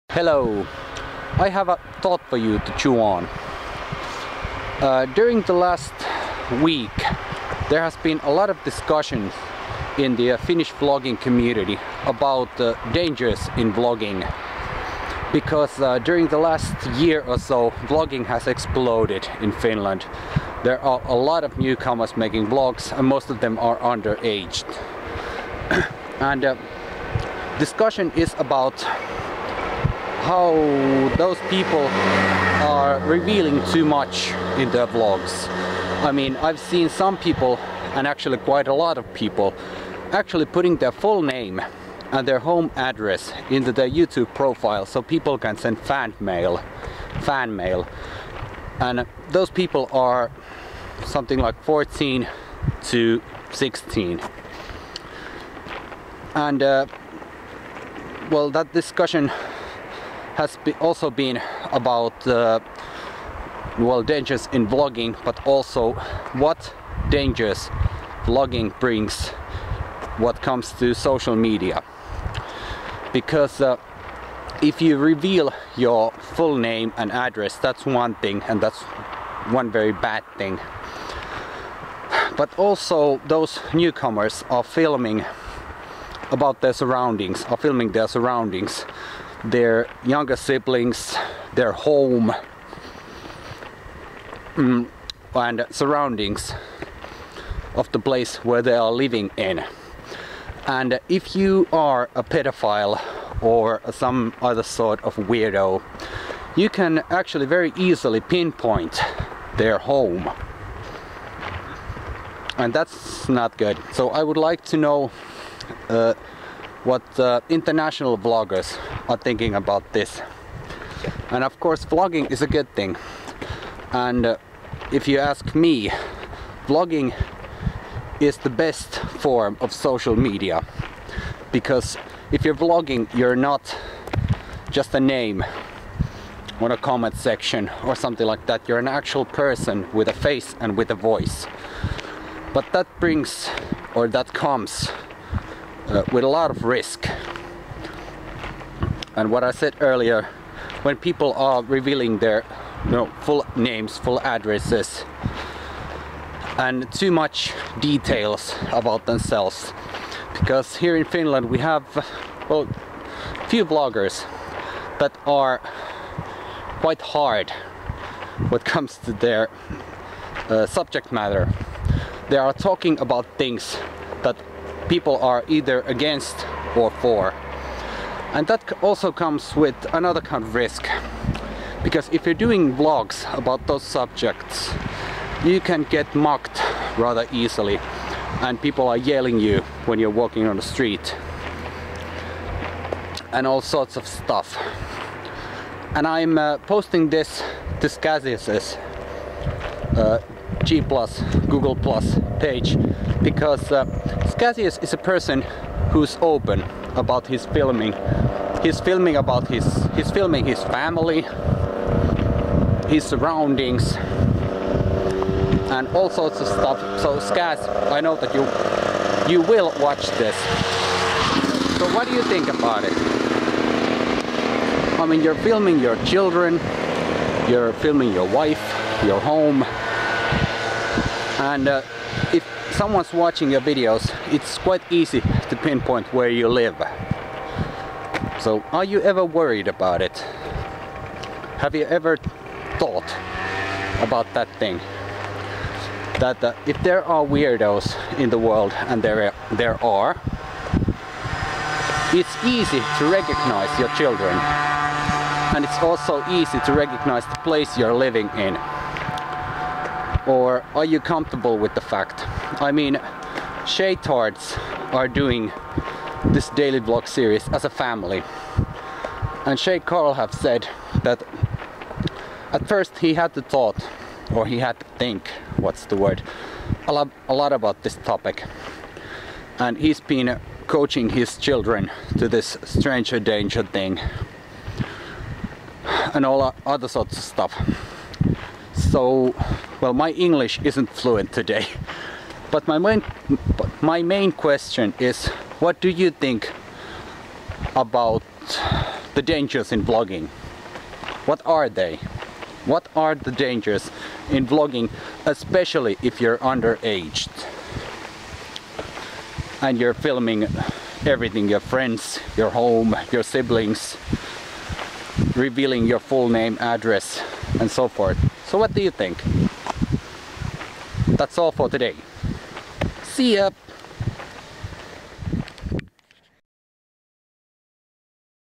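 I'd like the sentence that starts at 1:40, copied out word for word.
And if you are a pedophile or some other sort of weirdo, you can actually very easily pinpoint their home.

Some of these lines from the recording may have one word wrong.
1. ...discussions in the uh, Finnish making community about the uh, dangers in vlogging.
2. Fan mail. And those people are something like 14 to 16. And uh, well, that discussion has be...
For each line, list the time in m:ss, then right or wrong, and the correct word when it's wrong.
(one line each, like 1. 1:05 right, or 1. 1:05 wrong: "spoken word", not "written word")
1. 0:08 wrong: "vlogging", not "making"
2. 0:47 right.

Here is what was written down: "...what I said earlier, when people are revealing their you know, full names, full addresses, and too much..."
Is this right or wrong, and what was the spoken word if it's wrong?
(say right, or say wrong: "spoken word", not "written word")
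right.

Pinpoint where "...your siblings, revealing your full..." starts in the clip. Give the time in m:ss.
5:13.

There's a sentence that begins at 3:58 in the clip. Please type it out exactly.
So are you ever worried about it?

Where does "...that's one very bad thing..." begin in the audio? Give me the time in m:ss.
1:18.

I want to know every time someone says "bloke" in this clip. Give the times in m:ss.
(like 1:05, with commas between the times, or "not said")
not said.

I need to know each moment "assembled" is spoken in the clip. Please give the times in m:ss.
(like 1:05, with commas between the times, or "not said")
not said.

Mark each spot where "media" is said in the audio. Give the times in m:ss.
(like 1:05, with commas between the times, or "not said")
1:11, 2:10.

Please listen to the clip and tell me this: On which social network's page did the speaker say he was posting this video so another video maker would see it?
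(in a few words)
Google+.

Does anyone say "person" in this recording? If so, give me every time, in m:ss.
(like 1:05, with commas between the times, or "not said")
2:19, 3:24.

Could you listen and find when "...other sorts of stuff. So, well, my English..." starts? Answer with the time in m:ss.
4:46.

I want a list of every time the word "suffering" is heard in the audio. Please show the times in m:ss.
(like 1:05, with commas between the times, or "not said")
not said.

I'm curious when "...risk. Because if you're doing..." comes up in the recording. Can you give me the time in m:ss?
3:00.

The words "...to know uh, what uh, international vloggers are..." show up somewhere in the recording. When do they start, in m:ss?
1:54.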